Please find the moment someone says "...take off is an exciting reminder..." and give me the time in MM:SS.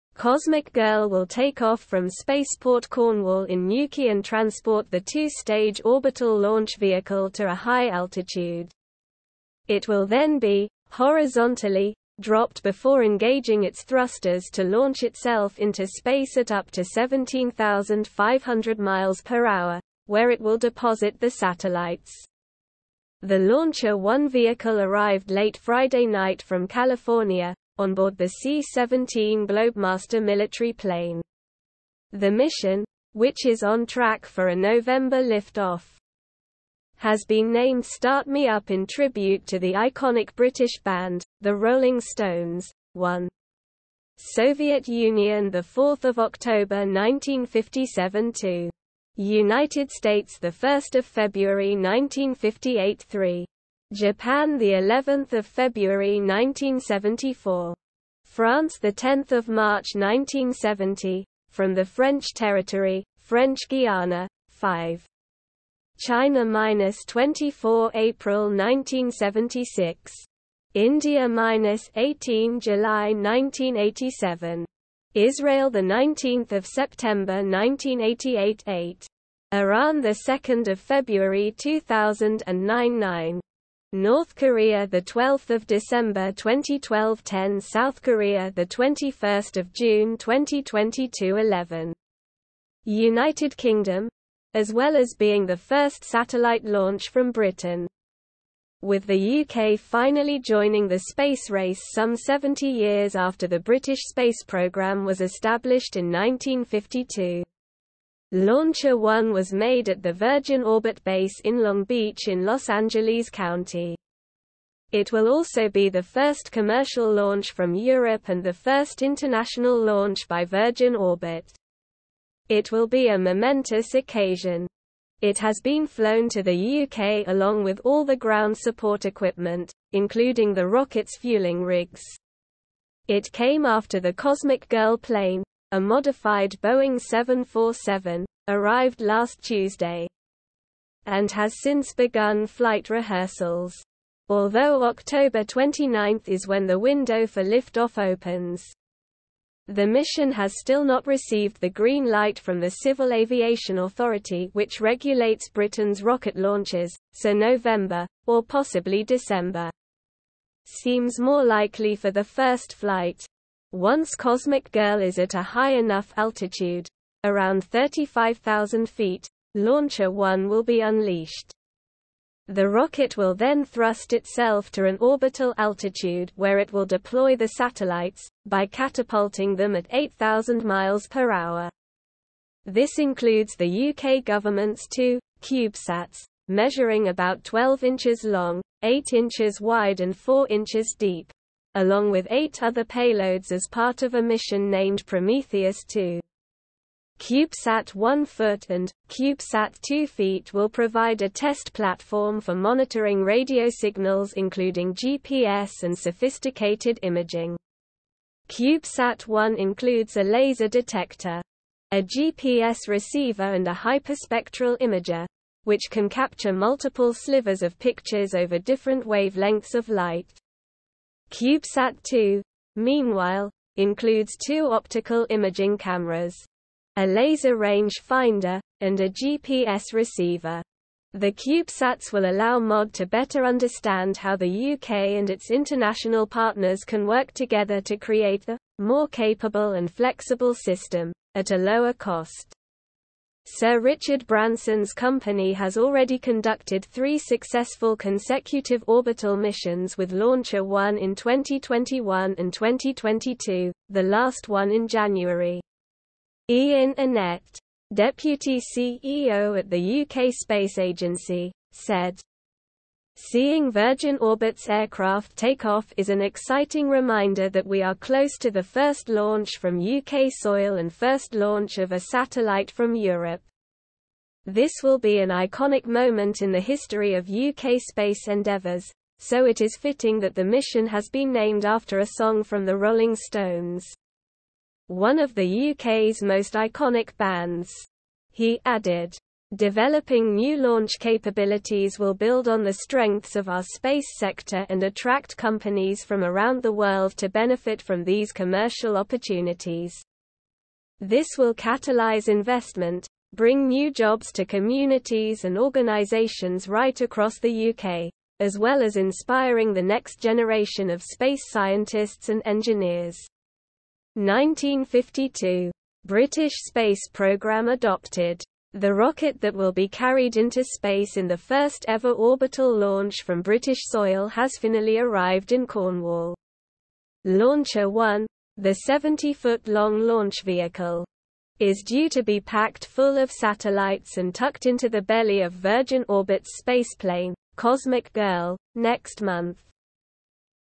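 04:25.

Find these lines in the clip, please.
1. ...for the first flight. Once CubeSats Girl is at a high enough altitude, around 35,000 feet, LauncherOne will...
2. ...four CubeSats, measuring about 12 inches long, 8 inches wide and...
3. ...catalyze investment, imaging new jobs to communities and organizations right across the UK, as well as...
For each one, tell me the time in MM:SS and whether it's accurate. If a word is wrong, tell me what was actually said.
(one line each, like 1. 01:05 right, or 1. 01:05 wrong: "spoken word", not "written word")
1. 02:41 wrong: "Cosmic", not "CubeSats"
2. 03:04 wrong: "two", not "four"
3. 05:01 wrong: "bring", not "imaging".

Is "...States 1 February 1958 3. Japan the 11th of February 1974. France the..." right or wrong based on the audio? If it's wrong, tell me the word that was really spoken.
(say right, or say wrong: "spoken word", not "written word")
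right.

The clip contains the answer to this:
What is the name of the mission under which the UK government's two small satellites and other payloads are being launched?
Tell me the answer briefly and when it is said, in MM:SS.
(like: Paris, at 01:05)
Prometheus 2, at 03:15.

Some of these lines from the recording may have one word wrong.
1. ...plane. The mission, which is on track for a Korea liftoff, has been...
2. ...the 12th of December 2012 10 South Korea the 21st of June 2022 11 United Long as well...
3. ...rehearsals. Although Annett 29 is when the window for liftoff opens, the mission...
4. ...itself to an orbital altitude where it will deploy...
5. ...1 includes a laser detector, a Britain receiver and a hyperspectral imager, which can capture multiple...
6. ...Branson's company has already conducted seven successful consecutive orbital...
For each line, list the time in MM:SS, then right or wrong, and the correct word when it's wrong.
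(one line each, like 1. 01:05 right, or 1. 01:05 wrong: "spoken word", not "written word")
1. 00:30 wrong: "November", not "Korea"
2. 01:24 wrong: "Kingdom", not "Long"
3. 02:22 wrong: "October", not "Annett"
4. 02:54 right
5. 03:29 wrong: "GPS", not "Britain"
6. 04:04 wrong: "three", not "seven".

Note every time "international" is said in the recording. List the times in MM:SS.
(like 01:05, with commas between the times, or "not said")
01:59, 03:55.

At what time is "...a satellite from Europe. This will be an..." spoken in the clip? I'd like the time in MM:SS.
04:31.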